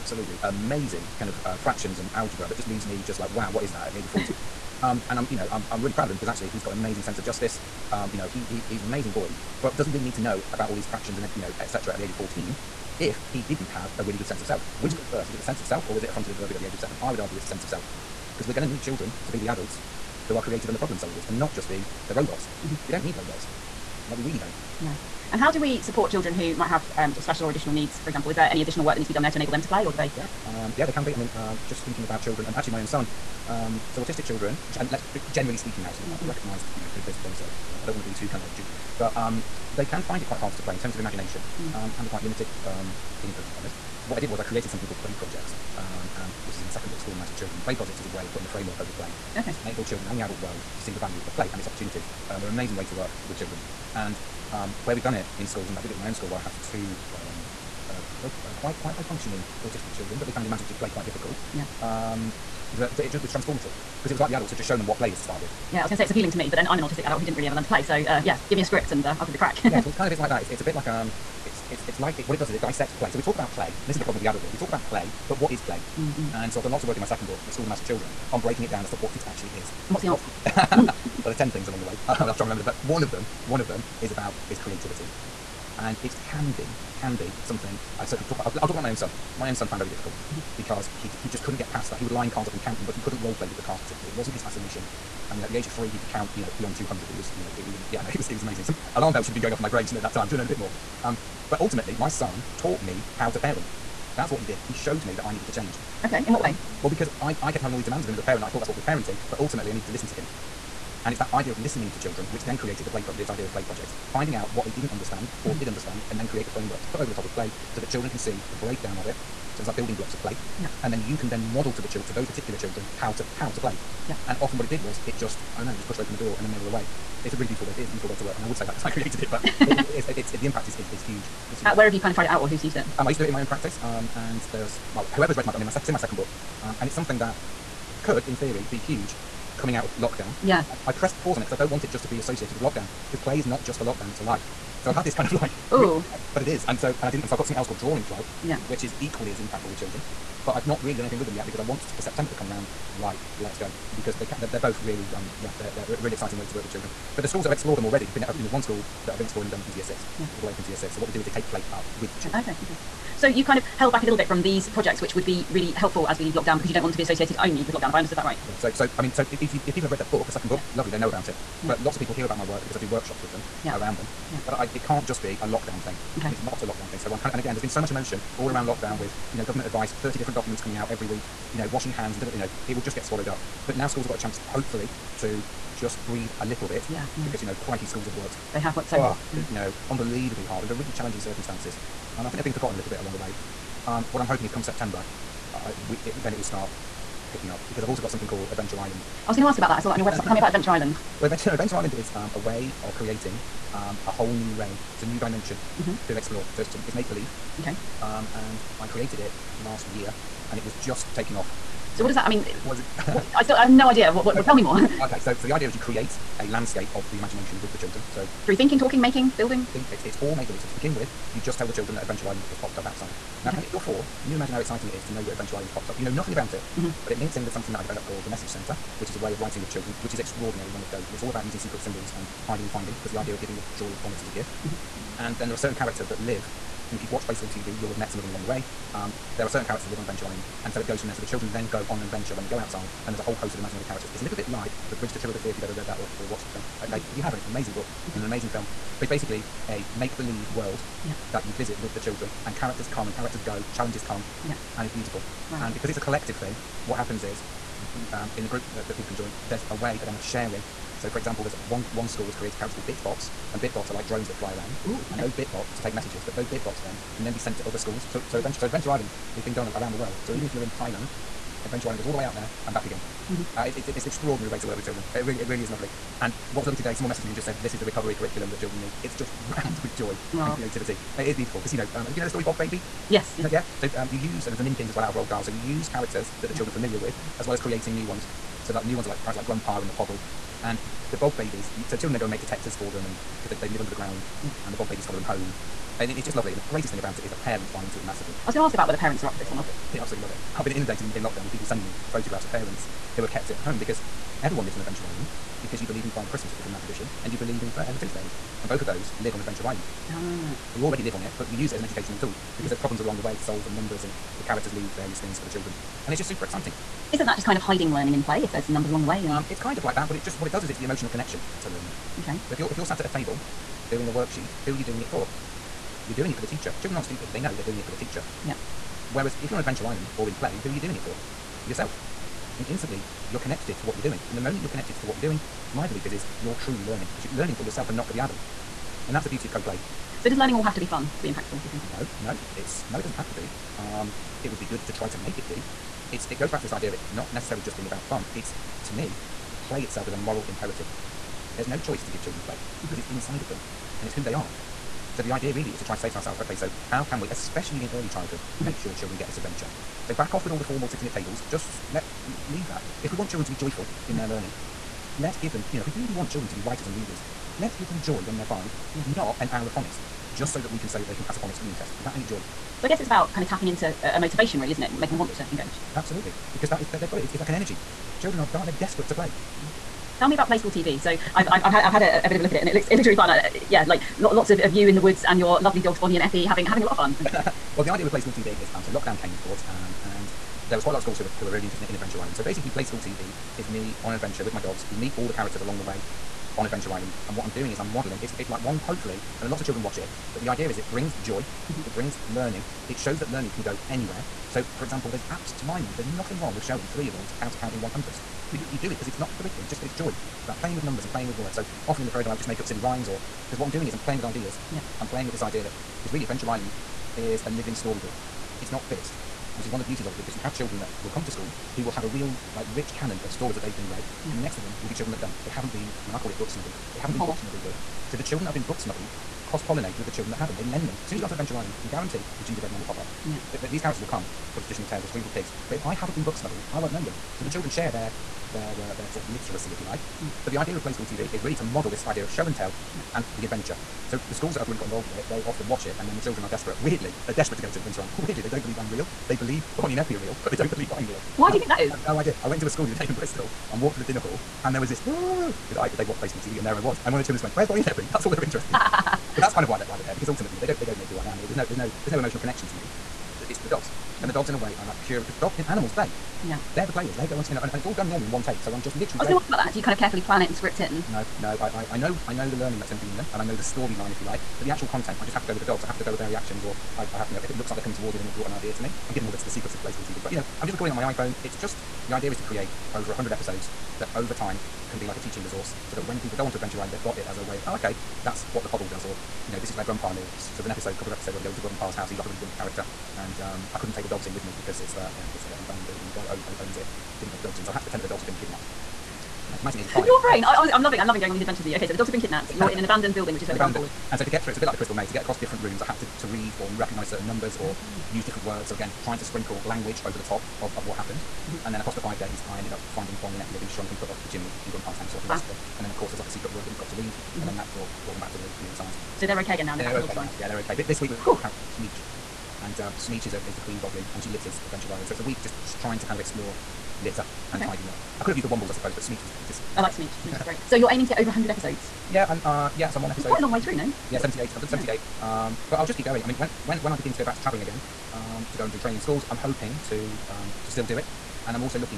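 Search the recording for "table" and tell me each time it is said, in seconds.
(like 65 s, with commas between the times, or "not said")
323 s, 361 s.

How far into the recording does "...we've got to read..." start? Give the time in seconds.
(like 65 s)
516 s.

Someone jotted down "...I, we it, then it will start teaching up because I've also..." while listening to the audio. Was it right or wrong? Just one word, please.
wrong.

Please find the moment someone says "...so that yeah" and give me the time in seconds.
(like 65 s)
485 s.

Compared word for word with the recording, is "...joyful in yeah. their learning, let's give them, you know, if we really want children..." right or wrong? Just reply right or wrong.
right.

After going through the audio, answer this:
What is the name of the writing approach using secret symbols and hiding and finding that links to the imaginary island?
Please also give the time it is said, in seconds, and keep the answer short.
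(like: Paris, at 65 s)
Message Center, at 228 s.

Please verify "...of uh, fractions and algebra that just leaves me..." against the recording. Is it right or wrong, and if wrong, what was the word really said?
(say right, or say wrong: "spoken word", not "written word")
right.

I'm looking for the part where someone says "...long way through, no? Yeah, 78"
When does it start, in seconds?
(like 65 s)
533 s.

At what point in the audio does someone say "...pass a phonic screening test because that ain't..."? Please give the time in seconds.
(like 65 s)
371 s.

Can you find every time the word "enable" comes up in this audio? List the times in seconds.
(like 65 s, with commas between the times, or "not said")
29 s, 49 s.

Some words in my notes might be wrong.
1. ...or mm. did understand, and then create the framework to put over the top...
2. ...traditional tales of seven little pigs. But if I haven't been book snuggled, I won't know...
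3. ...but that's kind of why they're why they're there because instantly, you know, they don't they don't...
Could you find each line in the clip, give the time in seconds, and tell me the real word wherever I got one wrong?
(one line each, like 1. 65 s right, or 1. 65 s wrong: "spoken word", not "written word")
1. 115 s right
2. 434 s wrong: "three", not "seven"
3. 458 s wrong: "ultimately", not "instantly".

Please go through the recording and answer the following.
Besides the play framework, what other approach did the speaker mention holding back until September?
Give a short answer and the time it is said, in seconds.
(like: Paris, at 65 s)
Drawing Club, at 147 s.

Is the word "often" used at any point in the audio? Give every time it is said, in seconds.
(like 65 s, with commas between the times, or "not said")
124 s, 411 s, 445 s.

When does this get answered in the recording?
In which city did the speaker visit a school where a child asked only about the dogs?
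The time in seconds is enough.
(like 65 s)
453 s.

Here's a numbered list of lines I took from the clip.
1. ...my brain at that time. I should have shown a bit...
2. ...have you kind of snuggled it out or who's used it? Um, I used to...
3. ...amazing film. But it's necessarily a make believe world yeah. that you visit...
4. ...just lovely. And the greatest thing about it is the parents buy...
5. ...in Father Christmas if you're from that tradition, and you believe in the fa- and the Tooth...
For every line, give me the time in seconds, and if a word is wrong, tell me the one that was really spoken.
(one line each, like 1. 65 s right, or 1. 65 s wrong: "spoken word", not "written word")
1. 99 s wrong: "known", not "shown"
2. 131 s wrong: "tried", not "snuggled"
3. 248 s wrong: "basically", not "necessarily"
4. 296 s right
5. 306 s right.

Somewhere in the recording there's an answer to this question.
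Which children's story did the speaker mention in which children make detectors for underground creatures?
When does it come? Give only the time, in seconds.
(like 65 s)
282 s.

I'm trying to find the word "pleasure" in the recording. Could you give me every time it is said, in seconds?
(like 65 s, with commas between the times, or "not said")
not said.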